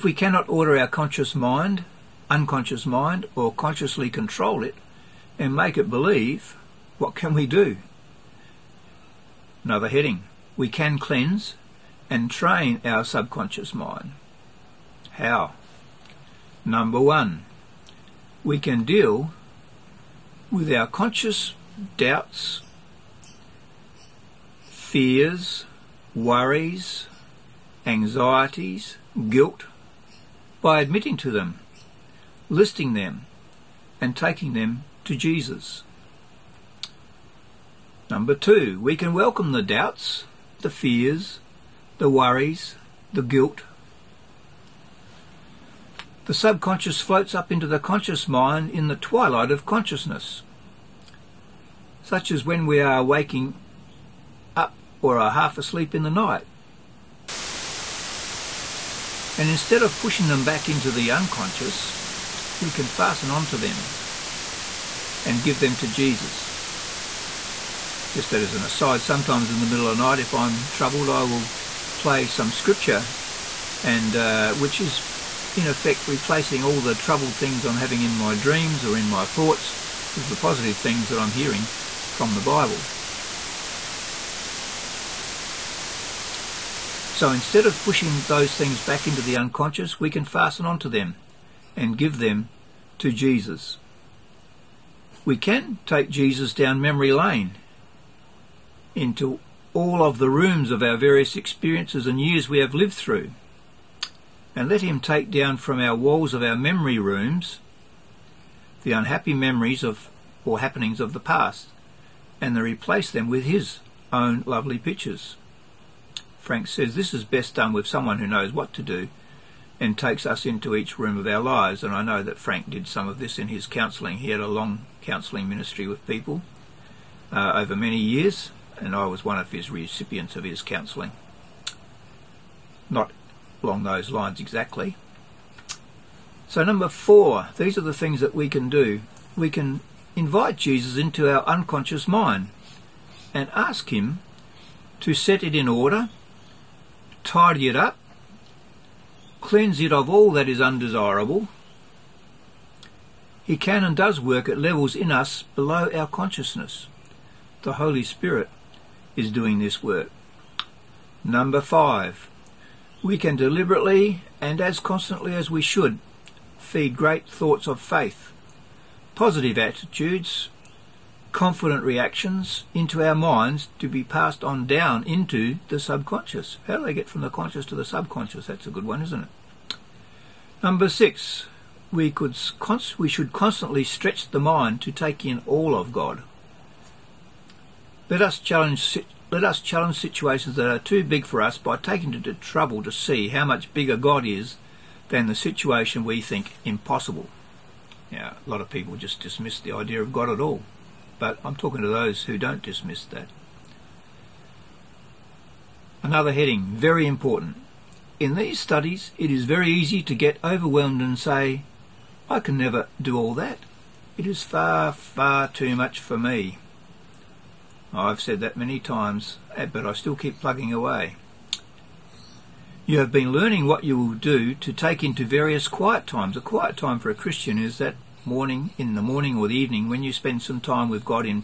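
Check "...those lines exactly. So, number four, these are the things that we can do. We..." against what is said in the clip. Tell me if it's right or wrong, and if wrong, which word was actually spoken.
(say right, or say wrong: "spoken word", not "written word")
right.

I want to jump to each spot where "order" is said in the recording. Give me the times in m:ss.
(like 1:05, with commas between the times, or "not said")
0:00, 2:25.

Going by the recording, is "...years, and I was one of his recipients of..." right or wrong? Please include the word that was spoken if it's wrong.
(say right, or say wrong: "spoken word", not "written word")
right.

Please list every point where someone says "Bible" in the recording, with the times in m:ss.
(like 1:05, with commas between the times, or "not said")
1:22.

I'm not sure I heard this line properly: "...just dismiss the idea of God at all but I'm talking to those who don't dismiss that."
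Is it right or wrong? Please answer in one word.
right.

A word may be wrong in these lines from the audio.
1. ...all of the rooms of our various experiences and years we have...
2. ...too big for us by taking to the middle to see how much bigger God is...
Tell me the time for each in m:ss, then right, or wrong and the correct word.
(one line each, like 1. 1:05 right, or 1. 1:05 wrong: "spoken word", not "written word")
1. 1:39 right
2. 3:10 wrong: "trouble", not "middle".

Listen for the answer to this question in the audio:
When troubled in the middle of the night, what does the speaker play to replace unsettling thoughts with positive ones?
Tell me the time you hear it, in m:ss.
1:12.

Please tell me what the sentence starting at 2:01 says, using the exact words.
And I know that Frank did some of this in his counselling.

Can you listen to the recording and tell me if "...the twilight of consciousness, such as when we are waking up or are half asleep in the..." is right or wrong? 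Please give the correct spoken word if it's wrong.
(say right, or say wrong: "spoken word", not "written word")
right.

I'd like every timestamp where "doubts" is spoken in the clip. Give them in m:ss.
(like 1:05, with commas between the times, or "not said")
0:21, 0:39.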